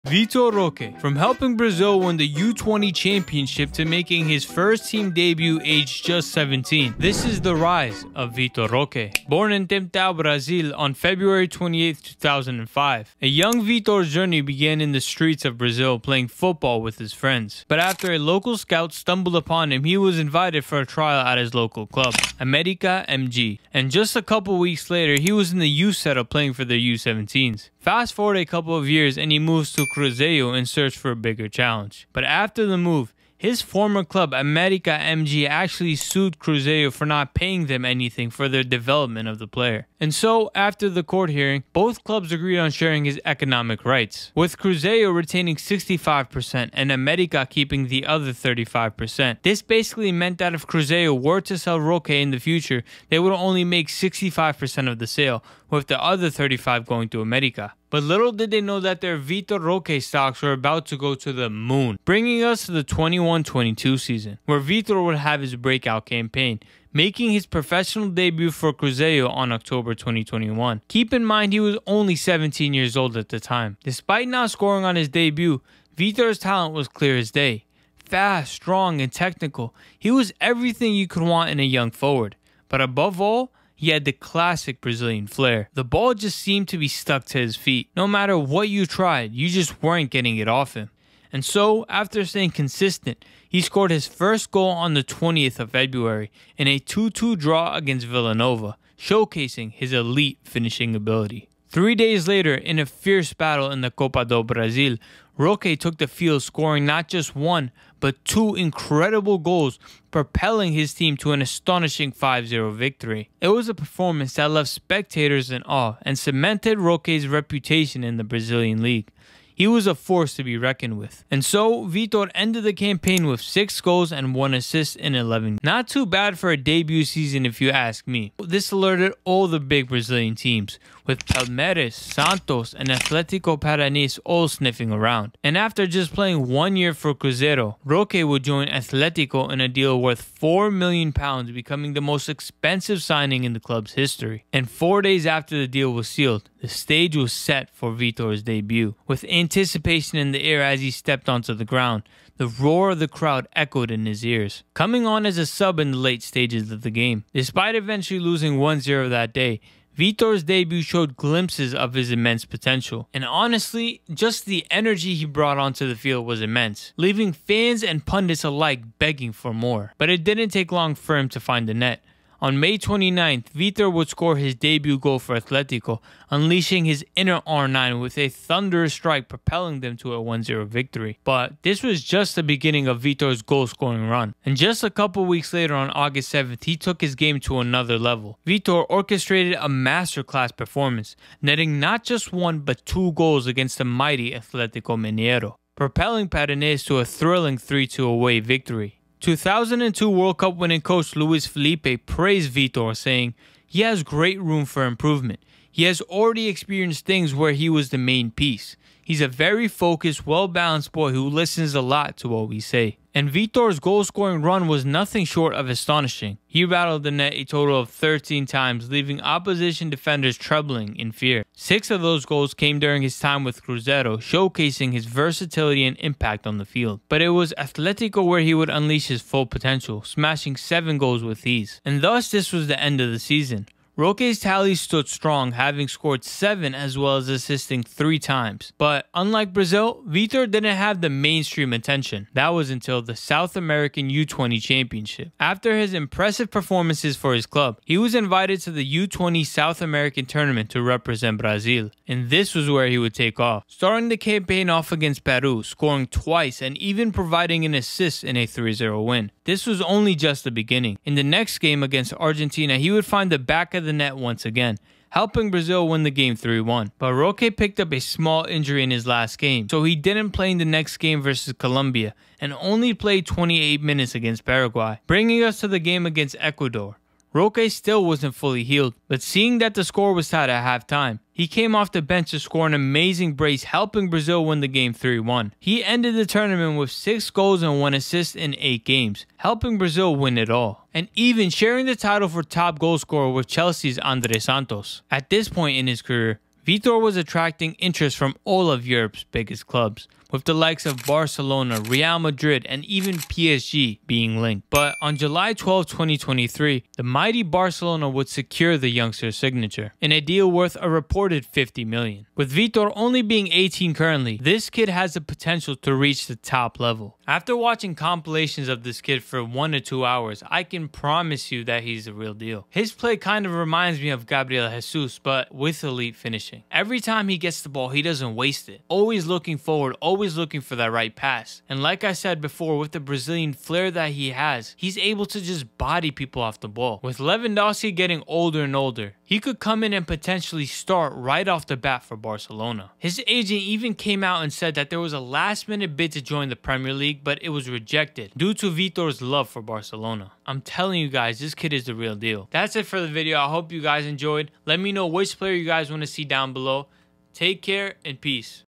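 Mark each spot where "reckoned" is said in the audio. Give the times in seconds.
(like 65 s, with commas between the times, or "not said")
120 s.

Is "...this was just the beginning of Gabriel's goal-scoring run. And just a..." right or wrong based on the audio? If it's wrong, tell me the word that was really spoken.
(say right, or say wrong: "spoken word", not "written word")
wrong: "Vitor", not "Gabriel".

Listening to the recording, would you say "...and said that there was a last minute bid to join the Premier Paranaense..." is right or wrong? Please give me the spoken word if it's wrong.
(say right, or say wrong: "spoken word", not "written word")
wrong: "League", not "Paranaense".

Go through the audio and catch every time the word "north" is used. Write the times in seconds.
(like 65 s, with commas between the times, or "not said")
not said.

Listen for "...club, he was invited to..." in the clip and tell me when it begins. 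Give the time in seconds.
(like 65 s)
247 s.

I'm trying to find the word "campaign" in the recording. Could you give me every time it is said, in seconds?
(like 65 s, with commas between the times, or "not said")
66 s, 122 s, 254 s.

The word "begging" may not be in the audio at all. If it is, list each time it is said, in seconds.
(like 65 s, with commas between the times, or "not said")
168 s.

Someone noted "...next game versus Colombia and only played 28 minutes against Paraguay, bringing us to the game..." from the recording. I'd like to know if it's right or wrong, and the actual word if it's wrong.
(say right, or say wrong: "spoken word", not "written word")
right.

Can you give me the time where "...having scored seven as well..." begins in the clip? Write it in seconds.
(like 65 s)
235 s.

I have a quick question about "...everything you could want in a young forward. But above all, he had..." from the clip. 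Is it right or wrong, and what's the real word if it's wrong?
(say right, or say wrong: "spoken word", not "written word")
right.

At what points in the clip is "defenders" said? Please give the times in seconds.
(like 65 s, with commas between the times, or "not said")
219 s.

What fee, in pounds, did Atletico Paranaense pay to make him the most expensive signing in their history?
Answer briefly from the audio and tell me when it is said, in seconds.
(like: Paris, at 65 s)
4 million pounds, at 140 s.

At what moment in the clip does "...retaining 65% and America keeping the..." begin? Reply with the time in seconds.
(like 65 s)
45 s.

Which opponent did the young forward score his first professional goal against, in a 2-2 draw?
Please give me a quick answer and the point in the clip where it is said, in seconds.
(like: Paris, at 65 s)
Villanova, at 98 s.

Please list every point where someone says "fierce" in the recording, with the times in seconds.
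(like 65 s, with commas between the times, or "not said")
102 s.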